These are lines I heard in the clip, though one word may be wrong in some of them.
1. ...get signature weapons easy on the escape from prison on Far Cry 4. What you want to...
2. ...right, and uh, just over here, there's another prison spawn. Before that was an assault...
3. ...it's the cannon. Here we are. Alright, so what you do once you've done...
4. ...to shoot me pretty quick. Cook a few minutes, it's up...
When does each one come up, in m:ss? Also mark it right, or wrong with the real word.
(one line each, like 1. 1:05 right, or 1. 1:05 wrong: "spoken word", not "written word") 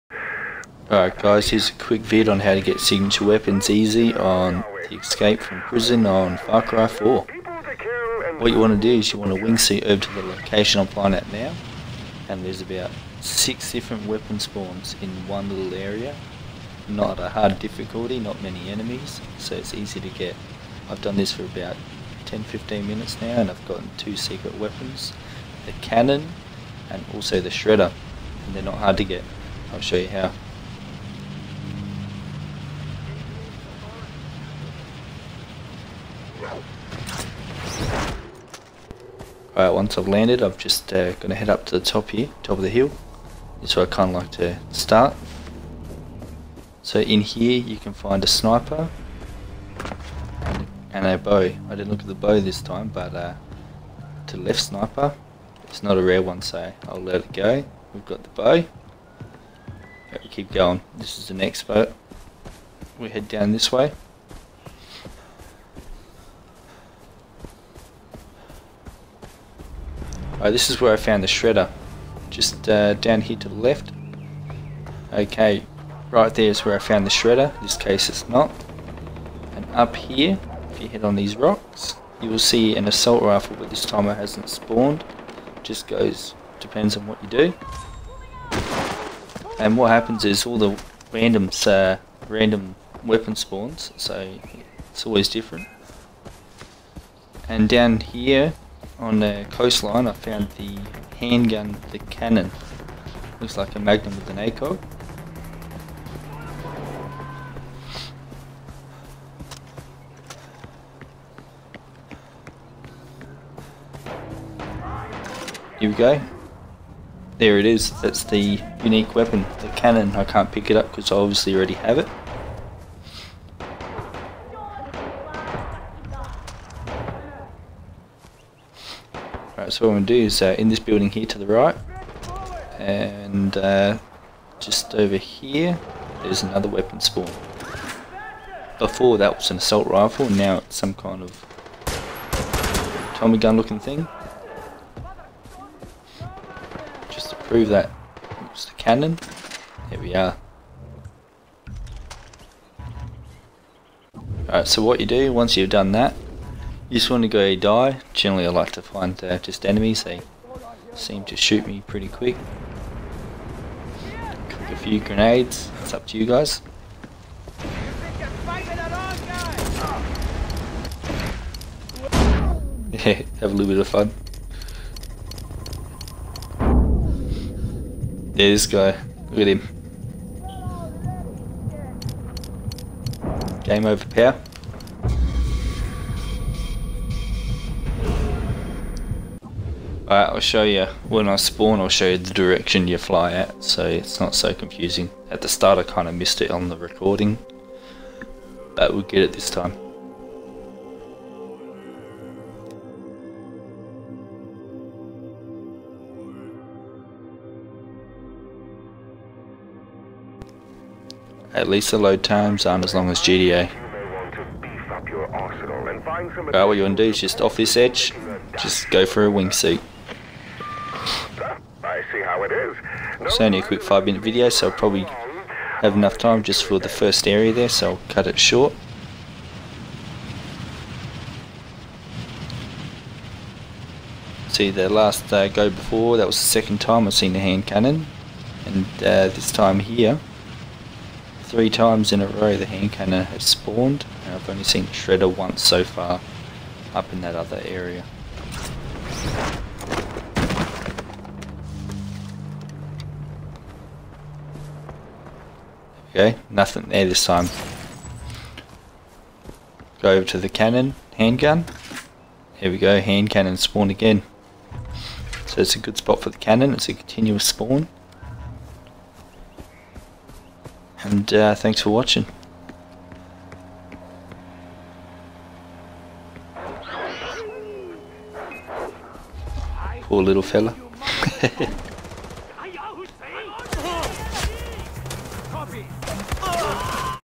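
1. 0:02 right
2. 2:11 wrong: "weapon", not "prison"
3. 2:28 right
4. 2:41 wrong: "grenades", not "minutes".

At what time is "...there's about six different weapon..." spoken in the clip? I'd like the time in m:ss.
0:12.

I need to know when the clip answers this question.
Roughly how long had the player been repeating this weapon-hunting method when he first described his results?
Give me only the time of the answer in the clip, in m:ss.
0:22.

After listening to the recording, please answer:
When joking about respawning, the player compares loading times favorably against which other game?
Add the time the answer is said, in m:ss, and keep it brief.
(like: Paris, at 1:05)
GTA, at 3:33.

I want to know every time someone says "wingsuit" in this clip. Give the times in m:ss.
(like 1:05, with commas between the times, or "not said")
0:09, 3:39.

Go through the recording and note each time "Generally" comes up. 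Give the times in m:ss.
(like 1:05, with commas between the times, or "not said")
2:38.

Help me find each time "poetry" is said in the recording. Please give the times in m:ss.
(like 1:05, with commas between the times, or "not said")
not said.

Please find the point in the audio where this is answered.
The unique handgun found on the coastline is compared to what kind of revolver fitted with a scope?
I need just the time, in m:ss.
1:43.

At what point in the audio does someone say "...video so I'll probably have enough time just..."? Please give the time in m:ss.
3:44.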